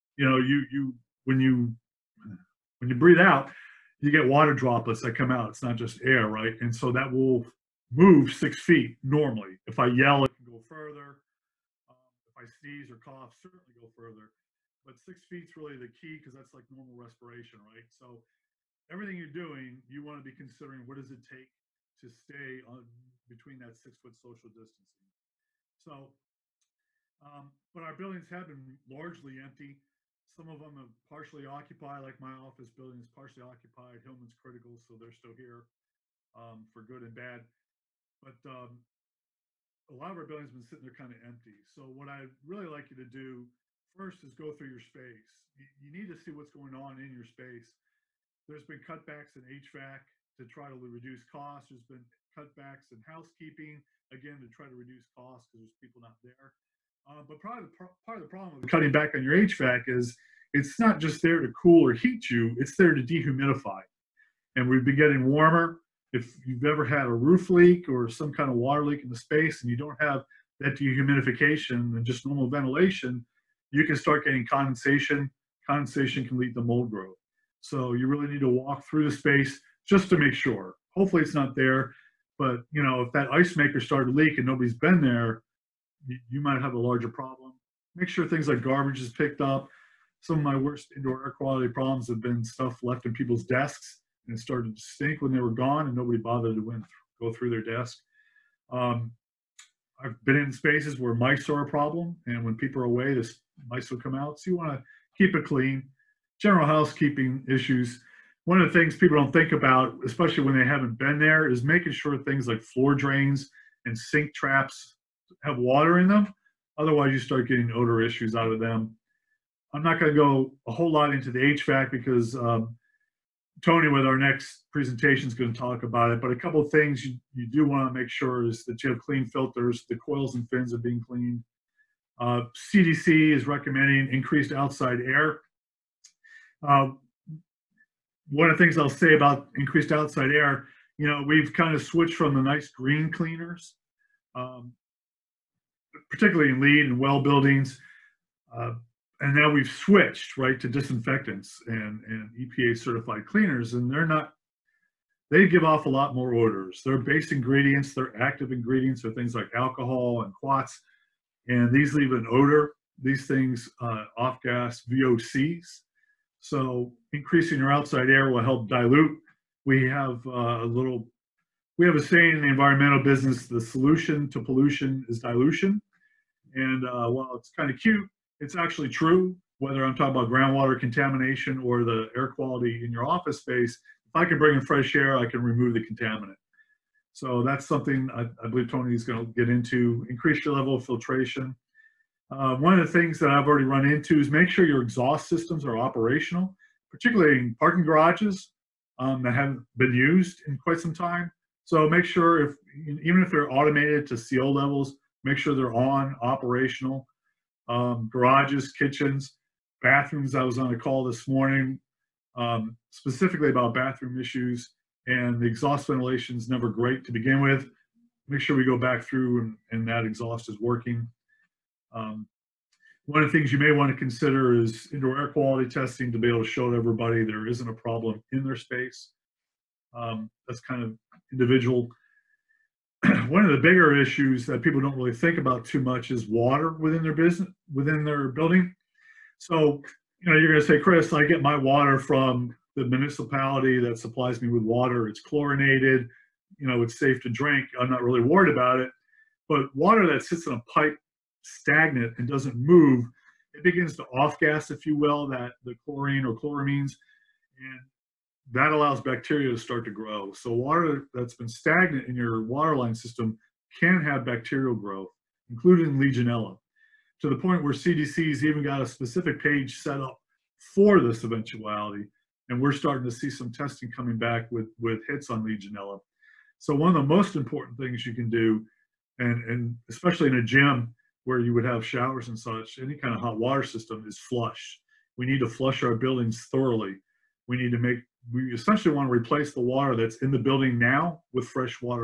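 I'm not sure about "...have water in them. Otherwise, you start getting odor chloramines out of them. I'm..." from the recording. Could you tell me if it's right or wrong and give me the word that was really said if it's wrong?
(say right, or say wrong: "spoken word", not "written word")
wrong: "issues", not "chloramines".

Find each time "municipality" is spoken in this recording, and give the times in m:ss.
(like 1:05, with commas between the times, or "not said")
4:02.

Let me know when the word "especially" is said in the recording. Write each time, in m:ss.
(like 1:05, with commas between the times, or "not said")
1:50, 4:39.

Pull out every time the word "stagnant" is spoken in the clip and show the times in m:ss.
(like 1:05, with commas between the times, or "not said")
4:11, 4:21.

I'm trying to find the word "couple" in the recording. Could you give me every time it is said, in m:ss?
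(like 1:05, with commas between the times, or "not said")
2:06.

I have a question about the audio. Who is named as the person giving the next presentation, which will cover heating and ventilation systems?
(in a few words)
Tony.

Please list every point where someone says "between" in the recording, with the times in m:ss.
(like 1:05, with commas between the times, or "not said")
0:23.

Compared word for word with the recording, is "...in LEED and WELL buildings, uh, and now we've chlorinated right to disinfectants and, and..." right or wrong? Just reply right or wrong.
wrong.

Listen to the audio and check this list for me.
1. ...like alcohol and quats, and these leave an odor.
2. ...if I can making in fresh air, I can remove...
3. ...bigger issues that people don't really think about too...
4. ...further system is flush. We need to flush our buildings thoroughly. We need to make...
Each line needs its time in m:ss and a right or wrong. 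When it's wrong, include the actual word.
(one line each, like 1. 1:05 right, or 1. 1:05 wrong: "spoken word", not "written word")
1. 2:39 right
2. 3:04 wrong: "bring", not "making"
3. 3:53 right
4. 4:43 wrong: "water", not "further".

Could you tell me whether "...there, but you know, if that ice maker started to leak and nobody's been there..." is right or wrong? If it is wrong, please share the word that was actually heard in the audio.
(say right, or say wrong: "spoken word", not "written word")
right.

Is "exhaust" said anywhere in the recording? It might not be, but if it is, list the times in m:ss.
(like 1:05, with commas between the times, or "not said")
3:14, 3:35, 3:40.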